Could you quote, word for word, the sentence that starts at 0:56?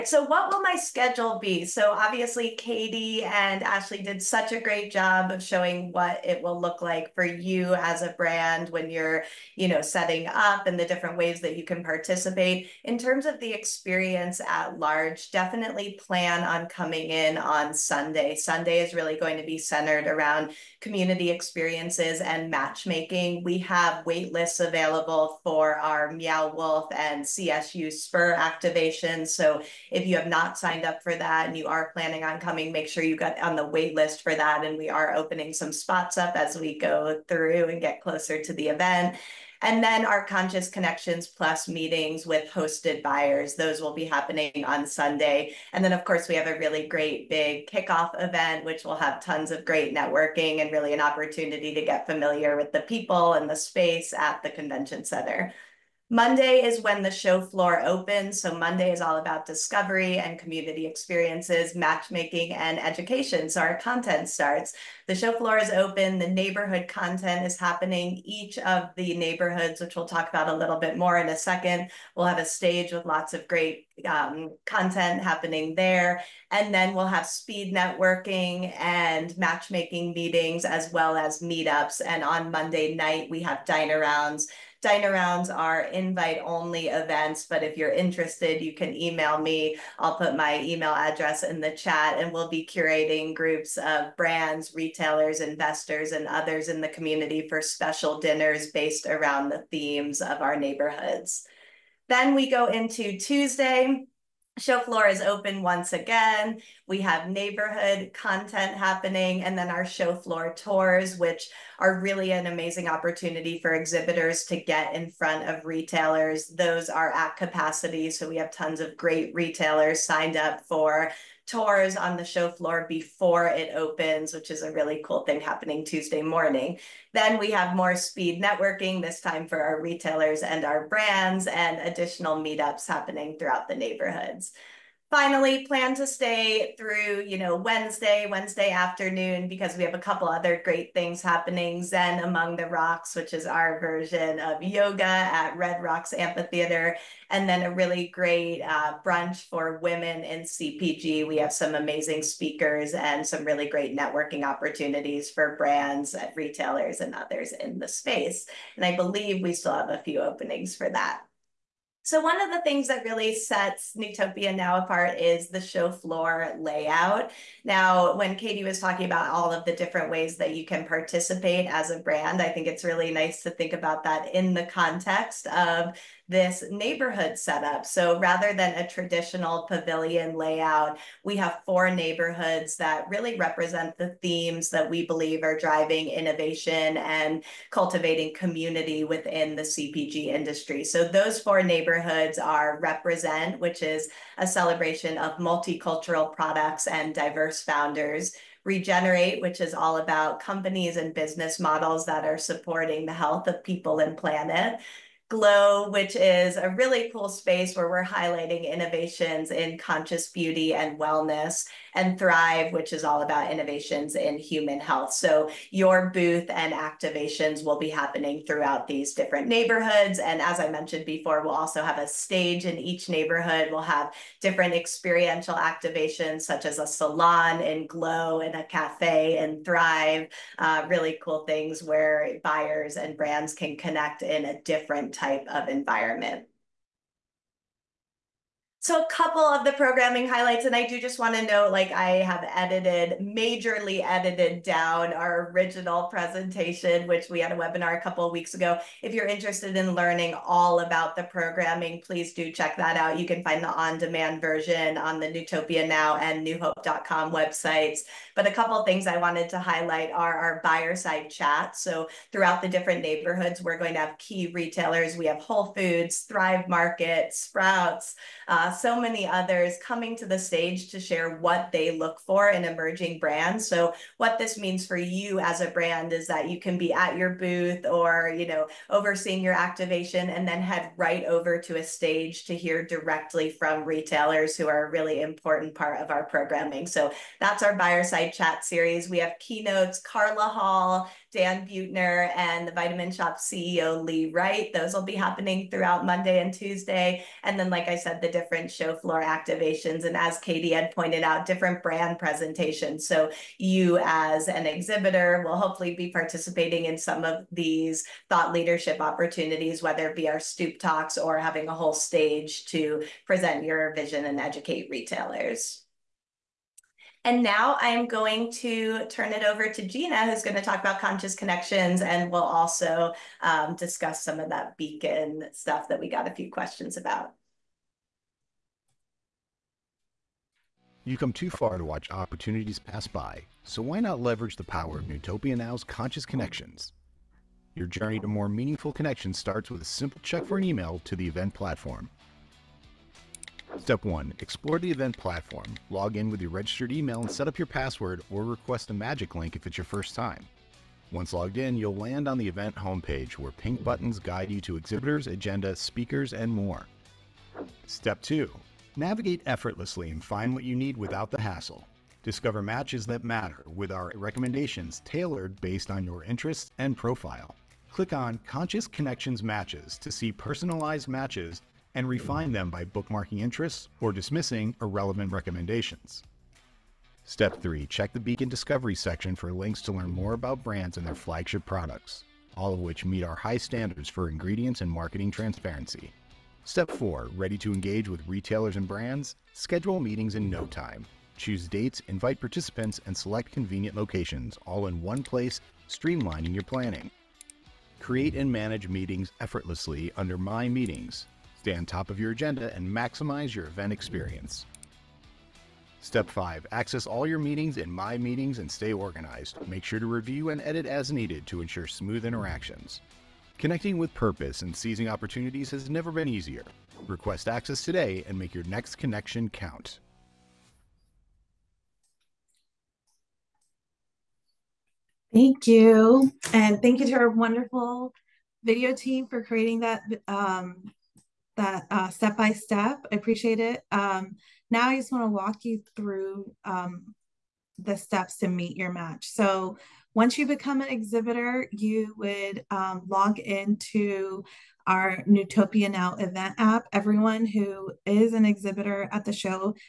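Monday is when the show floor opens.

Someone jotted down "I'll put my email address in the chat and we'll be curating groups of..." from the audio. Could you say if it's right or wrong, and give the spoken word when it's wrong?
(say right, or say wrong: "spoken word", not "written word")
right.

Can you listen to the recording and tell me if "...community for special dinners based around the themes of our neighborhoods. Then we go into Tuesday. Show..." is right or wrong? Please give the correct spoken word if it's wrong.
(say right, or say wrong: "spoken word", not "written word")
right.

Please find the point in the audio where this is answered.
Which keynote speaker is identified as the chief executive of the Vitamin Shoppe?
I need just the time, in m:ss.
4:54.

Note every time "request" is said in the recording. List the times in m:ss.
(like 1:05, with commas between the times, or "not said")
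5:48, 6:57.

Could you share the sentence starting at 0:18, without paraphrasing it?
Sunday is really going to be centered around community experiences and matchmaking.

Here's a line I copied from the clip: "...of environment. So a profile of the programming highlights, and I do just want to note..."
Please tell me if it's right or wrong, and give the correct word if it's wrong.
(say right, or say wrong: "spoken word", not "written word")
wrong: "couple", not "profile".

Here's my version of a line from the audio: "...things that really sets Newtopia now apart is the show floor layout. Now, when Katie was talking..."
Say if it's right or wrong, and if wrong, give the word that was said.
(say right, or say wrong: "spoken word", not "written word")
right.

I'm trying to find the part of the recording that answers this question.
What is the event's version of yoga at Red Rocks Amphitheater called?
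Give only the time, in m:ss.
2:21.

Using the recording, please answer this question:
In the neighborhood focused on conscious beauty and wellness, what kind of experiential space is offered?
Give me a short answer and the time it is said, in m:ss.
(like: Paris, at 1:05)
A salon, at 3:46.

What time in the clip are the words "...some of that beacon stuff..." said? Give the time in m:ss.
5:24.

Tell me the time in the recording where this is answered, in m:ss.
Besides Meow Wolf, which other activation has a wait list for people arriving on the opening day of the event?
0:27.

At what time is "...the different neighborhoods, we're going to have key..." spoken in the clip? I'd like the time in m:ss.
4:22.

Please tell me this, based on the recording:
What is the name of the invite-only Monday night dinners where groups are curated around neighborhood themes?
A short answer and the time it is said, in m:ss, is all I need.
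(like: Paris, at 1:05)
Dine arounds, at 1:23.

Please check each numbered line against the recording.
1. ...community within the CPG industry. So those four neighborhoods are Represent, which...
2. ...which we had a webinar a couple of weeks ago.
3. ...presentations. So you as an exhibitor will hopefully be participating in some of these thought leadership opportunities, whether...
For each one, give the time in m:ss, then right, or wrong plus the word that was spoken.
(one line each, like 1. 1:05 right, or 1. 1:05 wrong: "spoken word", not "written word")
1. 3:08 right
2. 4:07 right
3. 5:02 right.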